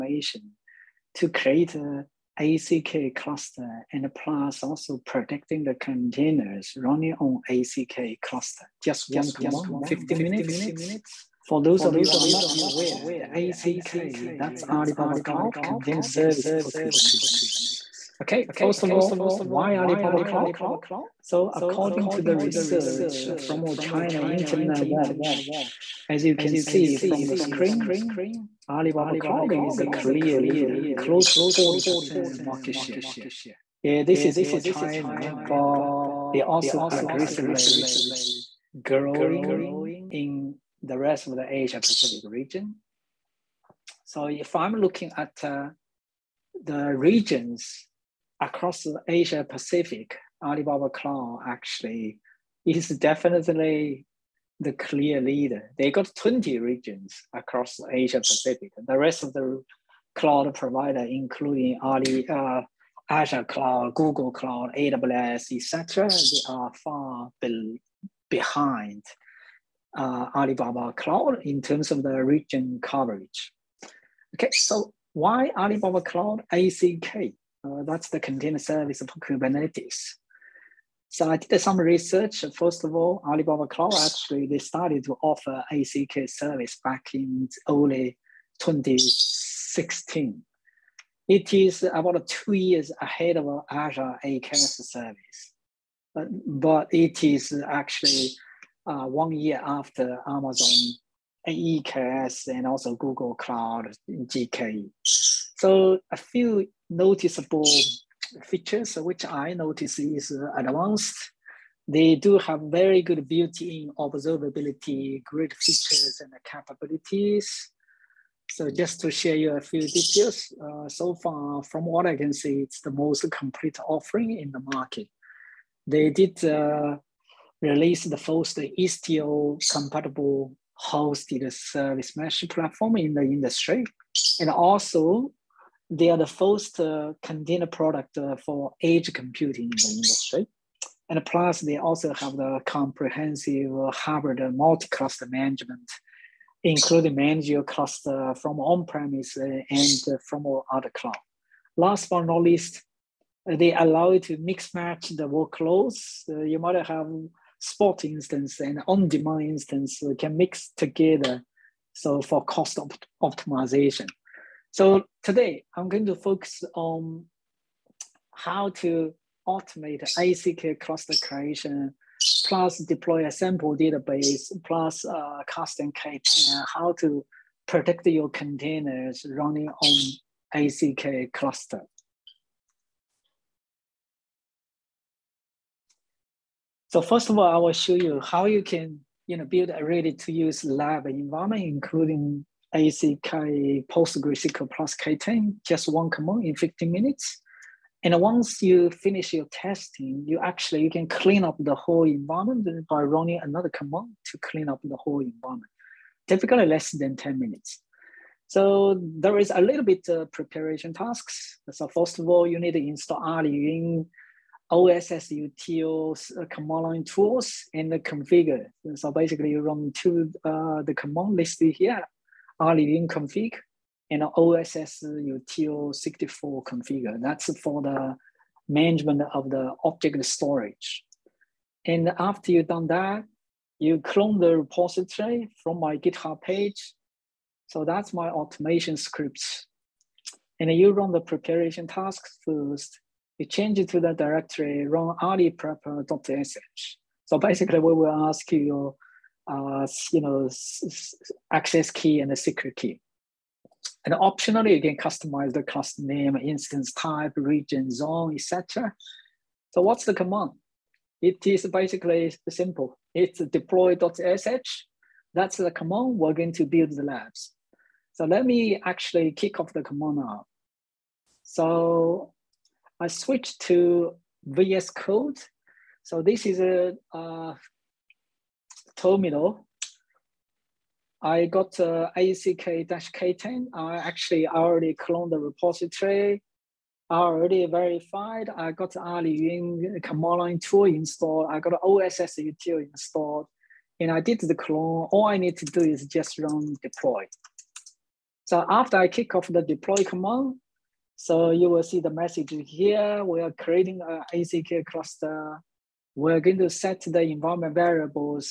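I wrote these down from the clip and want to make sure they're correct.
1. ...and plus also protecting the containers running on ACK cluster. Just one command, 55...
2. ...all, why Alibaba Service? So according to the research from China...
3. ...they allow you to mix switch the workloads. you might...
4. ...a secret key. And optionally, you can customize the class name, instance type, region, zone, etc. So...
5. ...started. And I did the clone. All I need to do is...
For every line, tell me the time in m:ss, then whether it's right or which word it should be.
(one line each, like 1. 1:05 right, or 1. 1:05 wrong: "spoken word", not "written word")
1. 0:03 wrong: "50", not "55"
2. 0:18 wrong: "Cloud", not "Service"
3. 2:33 wrong: "match", not "switch"
4. 4:12 right
5. 4:52 wrong: "installed", not "started".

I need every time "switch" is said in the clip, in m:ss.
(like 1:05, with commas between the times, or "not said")
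4:33.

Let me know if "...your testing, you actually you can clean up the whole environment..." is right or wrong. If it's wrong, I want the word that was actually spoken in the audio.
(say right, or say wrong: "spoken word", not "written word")
right.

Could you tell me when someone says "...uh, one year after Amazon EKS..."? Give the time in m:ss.
1:38.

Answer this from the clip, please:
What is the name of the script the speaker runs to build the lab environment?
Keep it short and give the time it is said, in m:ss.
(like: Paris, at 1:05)
deploy.sh, at 4:23.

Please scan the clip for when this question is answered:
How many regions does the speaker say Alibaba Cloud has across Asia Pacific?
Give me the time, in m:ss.
0:56.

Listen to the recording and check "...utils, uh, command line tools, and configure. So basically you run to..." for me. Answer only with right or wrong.
right.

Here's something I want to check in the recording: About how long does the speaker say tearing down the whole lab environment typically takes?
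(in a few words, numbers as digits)
less than 10 minutes.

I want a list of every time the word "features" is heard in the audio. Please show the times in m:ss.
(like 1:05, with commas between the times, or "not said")
1:48, 1:55.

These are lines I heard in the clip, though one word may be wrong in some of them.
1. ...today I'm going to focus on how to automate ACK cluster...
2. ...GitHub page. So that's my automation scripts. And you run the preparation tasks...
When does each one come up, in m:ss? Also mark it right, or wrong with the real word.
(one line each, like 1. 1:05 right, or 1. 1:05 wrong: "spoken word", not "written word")
1. 2:45 right
2. 3:55 right.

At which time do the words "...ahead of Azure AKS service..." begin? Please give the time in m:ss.
1:33.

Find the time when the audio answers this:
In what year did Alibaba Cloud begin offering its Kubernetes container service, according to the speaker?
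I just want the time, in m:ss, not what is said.
1:27.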